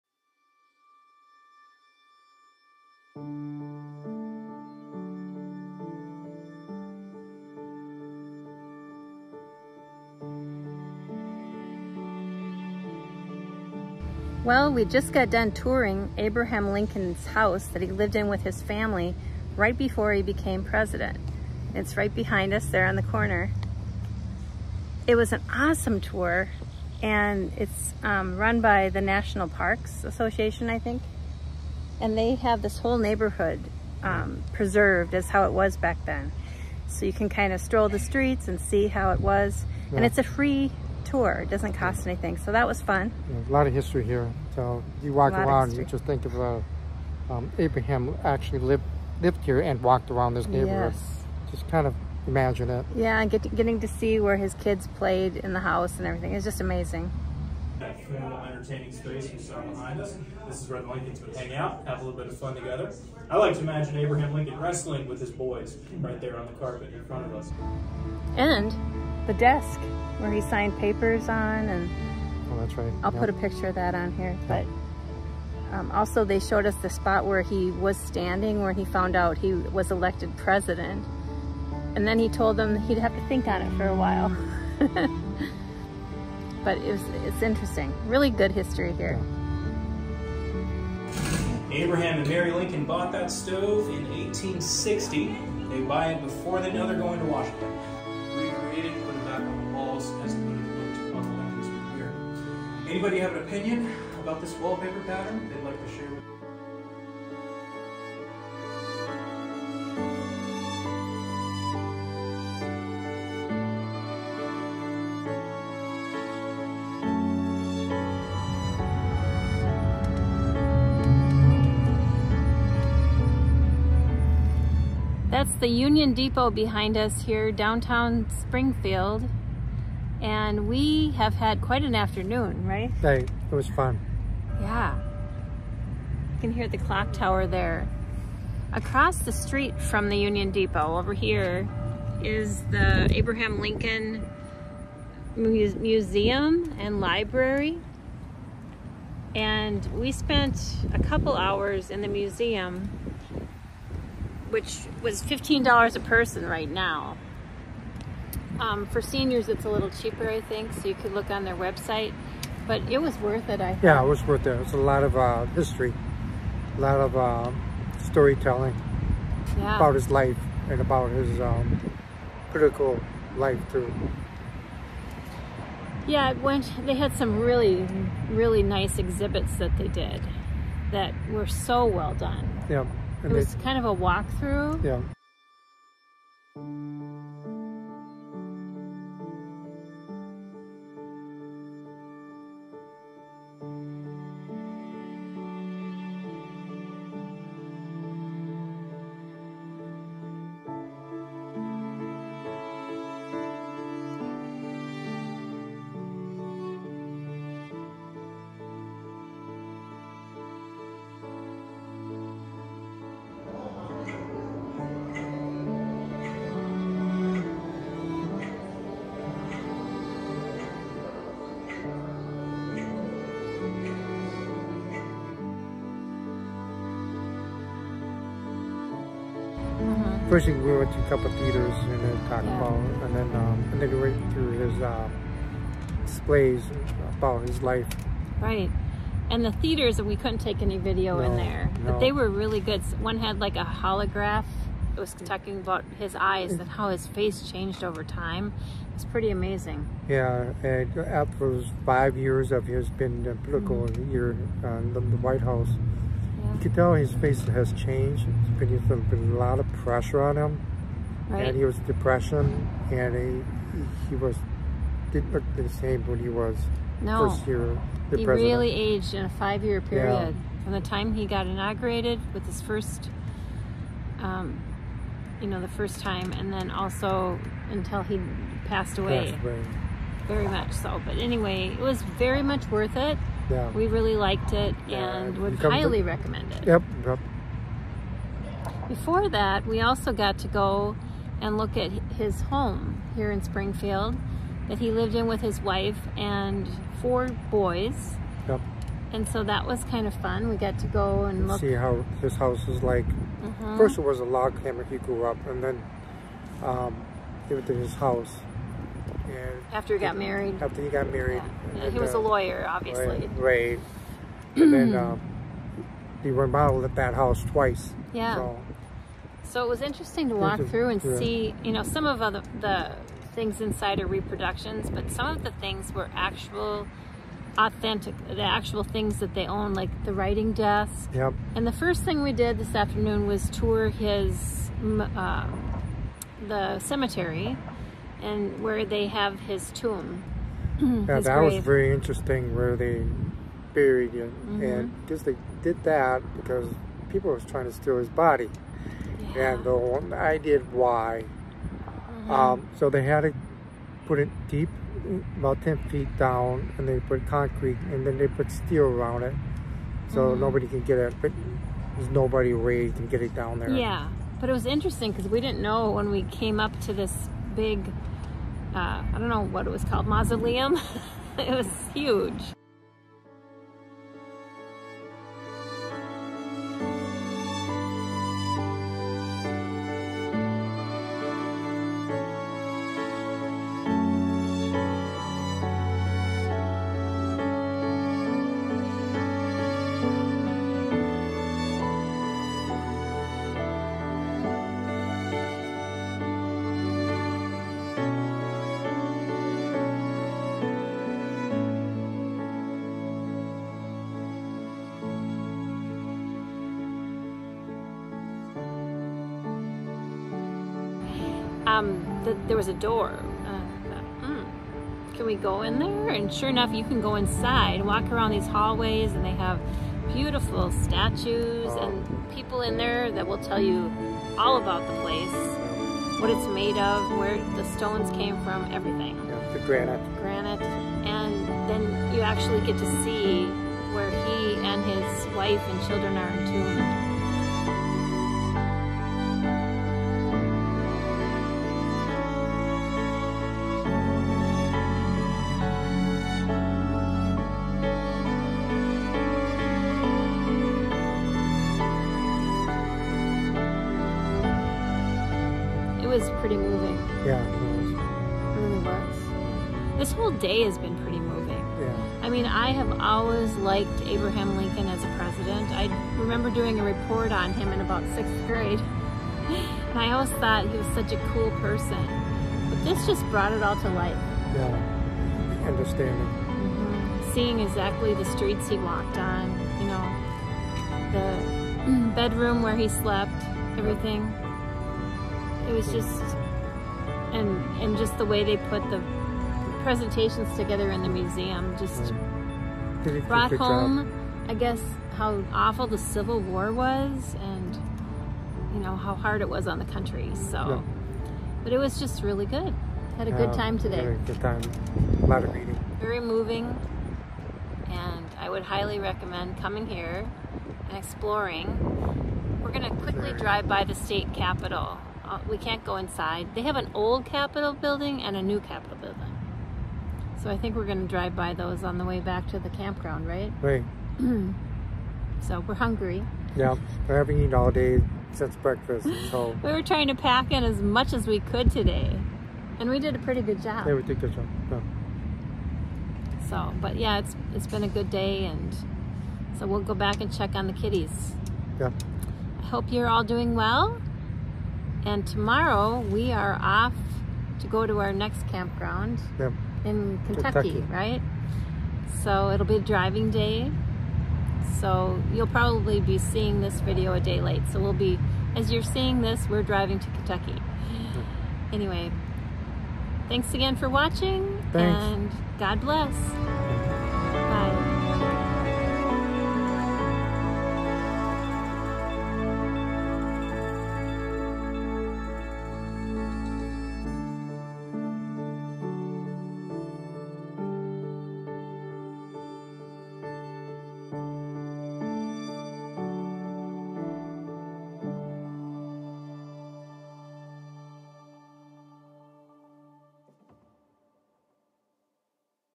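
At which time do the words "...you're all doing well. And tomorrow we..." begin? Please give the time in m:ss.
9:02.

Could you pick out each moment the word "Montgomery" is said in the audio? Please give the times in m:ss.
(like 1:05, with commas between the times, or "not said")
not said.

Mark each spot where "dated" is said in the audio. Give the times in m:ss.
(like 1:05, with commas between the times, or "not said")
not said.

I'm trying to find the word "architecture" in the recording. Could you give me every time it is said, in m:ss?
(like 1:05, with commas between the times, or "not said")
not said.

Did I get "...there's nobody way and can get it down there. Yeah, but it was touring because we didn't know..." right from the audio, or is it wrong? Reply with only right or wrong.
wrong.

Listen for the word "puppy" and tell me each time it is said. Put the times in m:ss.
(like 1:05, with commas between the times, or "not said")
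not said.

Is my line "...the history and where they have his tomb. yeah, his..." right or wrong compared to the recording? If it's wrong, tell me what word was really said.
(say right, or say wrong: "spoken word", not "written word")
wrong: "cemetery", not "history".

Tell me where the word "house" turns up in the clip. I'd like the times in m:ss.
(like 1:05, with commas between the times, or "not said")
0:17, 0:55, 4:15, 5:02, 5:08, 5:17.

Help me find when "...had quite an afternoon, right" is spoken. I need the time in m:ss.
2:11.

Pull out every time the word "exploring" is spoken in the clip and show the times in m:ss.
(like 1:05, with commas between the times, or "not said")
8:30.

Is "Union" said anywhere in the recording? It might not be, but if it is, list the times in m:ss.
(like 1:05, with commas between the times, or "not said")
2:05, 2:20.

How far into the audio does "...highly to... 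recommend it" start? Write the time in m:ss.
4:45.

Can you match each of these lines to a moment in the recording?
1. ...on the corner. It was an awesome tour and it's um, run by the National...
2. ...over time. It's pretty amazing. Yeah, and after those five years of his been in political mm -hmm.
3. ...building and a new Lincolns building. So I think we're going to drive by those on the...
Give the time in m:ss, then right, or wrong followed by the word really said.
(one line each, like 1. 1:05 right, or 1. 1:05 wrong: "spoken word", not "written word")
1. 0:22 right
2. 4:07 right
3. 8:37 wrong: "Capitol", not "Lincolns".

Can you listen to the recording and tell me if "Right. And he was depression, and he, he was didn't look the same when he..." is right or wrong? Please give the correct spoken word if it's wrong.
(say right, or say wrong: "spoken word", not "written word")
right.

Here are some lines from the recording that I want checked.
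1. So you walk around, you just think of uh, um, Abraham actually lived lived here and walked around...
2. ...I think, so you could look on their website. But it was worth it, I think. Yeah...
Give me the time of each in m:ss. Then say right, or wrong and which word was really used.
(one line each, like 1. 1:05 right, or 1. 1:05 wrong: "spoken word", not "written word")
1. 0:44 right
2. 2:40 right.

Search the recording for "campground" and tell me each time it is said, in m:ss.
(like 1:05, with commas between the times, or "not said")
8:42, 9:08.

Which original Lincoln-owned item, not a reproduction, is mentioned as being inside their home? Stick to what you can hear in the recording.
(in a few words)
Writing desk.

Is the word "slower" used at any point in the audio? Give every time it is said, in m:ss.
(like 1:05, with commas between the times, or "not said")
not said.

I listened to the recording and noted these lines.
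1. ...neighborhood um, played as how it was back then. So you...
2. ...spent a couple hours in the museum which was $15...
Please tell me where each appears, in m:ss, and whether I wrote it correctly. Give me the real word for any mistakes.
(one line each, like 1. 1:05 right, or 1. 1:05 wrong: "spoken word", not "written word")
1. 0:32 wrong: "preserved", not "played"
2. 2:30 right.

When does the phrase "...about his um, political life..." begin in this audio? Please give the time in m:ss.
2:50.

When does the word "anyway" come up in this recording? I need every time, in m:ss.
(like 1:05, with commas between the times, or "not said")
4:41, 9:21.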